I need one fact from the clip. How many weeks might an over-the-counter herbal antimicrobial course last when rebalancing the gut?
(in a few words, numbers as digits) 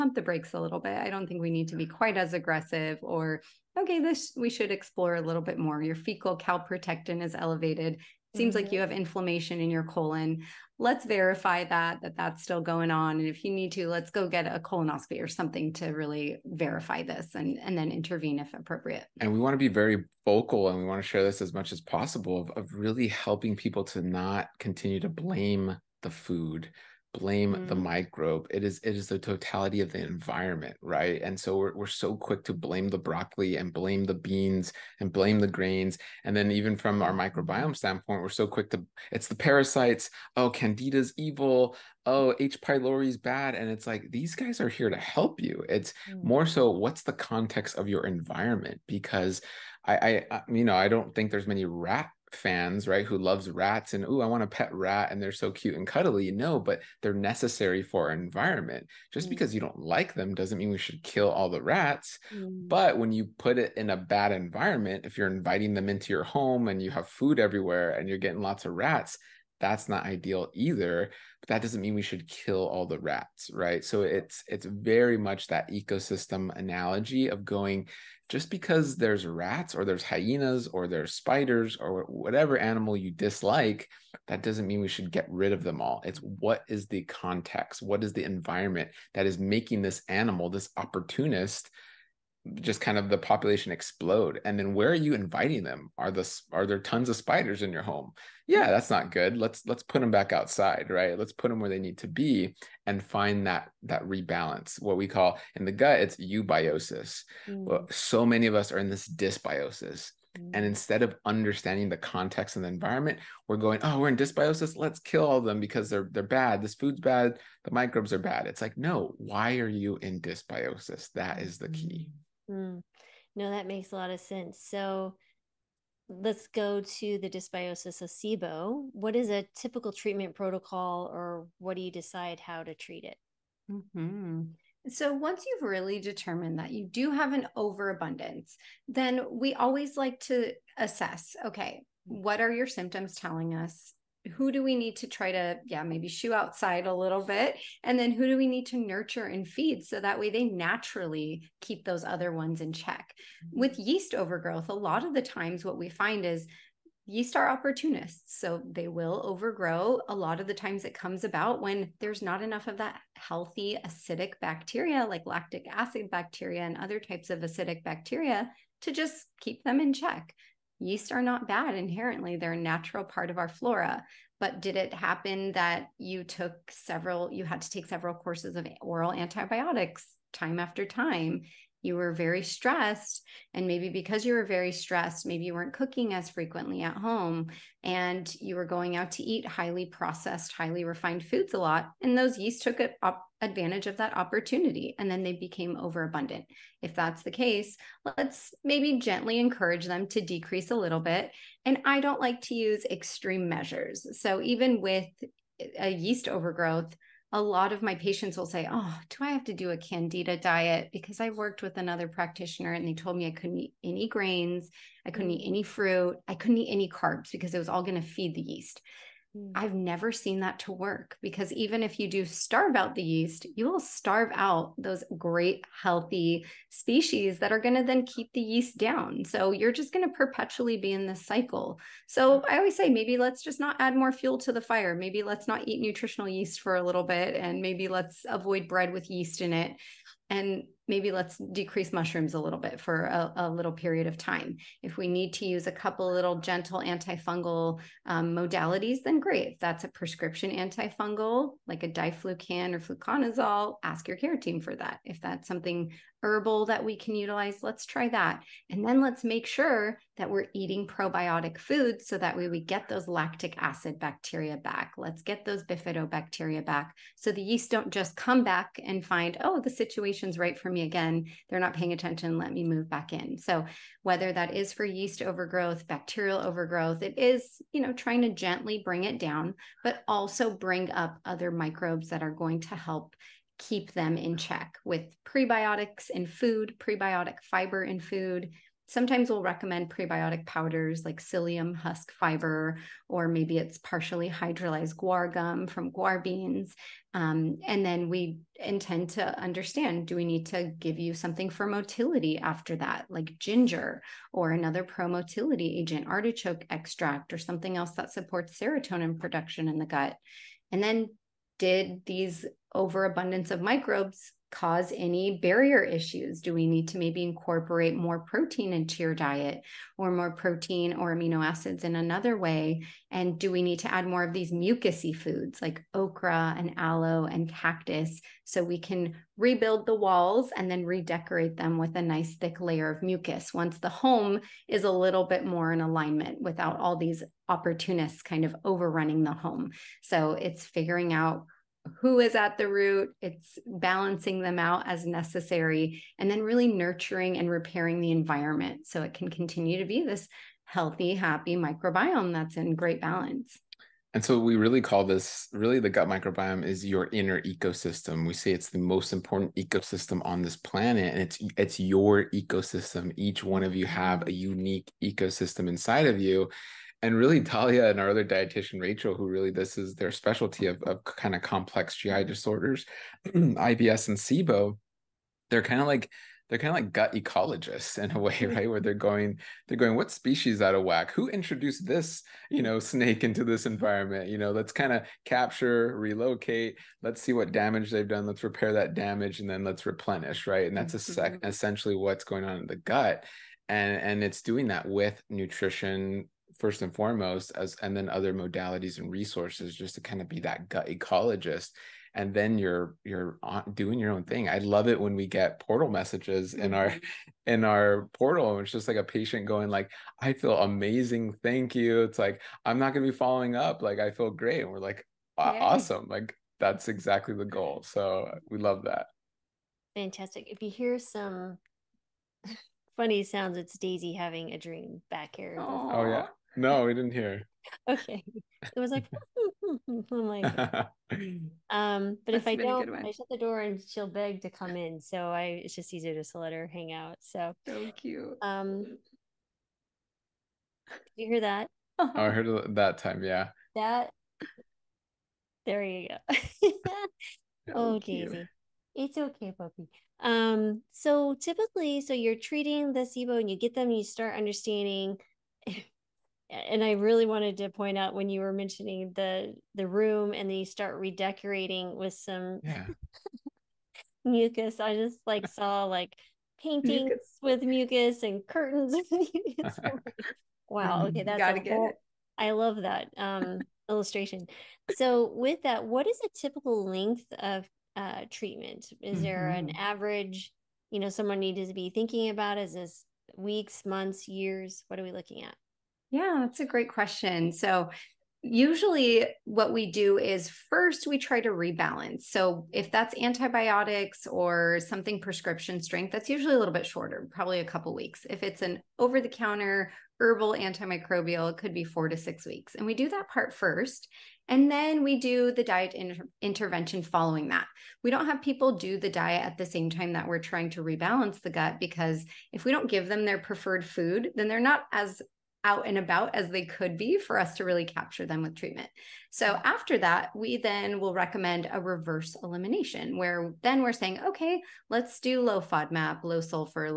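4 to 6 weeks.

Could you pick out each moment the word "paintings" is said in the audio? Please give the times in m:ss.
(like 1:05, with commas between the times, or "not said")
7:46.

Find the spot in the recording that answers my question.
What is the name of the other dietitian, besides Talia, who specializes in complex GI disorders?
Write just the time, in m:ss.
6:08.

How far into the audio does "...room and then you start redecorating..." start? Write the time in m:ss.
7:39.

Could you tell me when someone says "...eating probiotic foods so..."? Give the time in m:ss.
4:20.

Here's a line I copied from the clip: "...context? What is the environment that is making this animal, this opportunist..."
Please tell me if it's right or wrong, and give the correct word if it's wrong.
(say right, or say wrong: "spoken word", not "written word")
right.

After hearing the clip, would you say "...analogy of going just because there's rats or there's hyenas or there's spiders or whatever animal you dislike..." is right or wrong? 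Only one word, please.
right.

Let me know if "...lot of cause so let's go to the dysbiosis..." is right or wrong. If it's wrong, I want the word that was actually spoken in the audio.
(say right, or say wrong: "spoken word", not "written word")
wrong: "sense", not "cause".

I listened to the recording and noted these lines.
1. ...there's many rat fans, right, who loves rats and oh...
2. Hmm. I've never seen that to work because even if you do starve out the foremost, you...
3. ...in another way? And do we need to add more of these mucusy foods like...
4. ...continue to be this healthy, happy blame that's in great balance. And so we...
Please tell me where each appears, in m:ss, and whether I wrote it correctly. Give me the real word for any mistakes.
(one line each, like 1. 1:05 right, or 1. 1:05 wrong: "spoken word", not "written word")
1. 0:51 right
2. 3:39 wrong: "yeast", not "foremost"
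3. 5:21 right
4. 5:49 wrong: "microbiome", not "blame".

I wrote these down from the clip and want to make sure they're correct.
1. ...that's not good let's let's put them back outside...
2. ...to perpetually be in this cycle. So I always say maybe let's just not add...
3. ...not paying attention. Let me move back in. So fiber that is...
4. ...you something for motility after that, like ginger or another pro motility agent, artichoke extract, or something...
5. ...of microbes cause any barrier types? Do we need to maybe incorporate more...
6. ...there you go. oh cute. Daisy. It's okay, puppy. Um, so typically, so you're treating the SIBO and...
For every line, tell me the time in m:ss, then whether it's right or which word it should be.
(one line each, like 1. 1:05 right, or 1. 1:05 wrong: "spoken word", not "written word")
1. 1:38 right
2. 3:50 right
3. 4:31 wrong: "whether", not "fiber"
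4. 5:00 right
5. 5:13 wrong: "issues", not "types"
6. 7:25 right.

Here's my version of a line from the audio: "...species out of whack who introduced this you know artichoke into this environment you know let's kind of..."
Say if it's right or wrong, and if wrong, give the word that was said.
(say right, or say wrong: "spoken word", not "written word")
wrong: "snake", not "artichoke".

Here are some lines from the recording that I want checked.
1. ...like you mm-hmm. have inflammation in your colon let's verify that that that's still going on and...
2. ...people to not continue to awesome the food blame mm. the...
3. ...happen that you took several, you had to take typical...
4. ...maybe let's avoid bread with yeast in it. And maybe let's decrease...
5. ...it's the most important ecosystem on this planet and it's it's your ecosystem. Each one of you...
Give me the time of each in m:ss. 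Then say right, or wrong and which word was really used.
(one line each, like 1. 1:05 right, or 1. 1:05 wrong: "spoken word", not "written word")
1. 0:08 right
2. 0:23 wrong: "blame", not "awesome"
3. 2:54 wrong: "several", not "typical"
4. 3:57 right
5. 5:58 right.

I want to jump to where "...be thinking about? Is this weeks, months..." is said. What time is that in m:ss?
8:01.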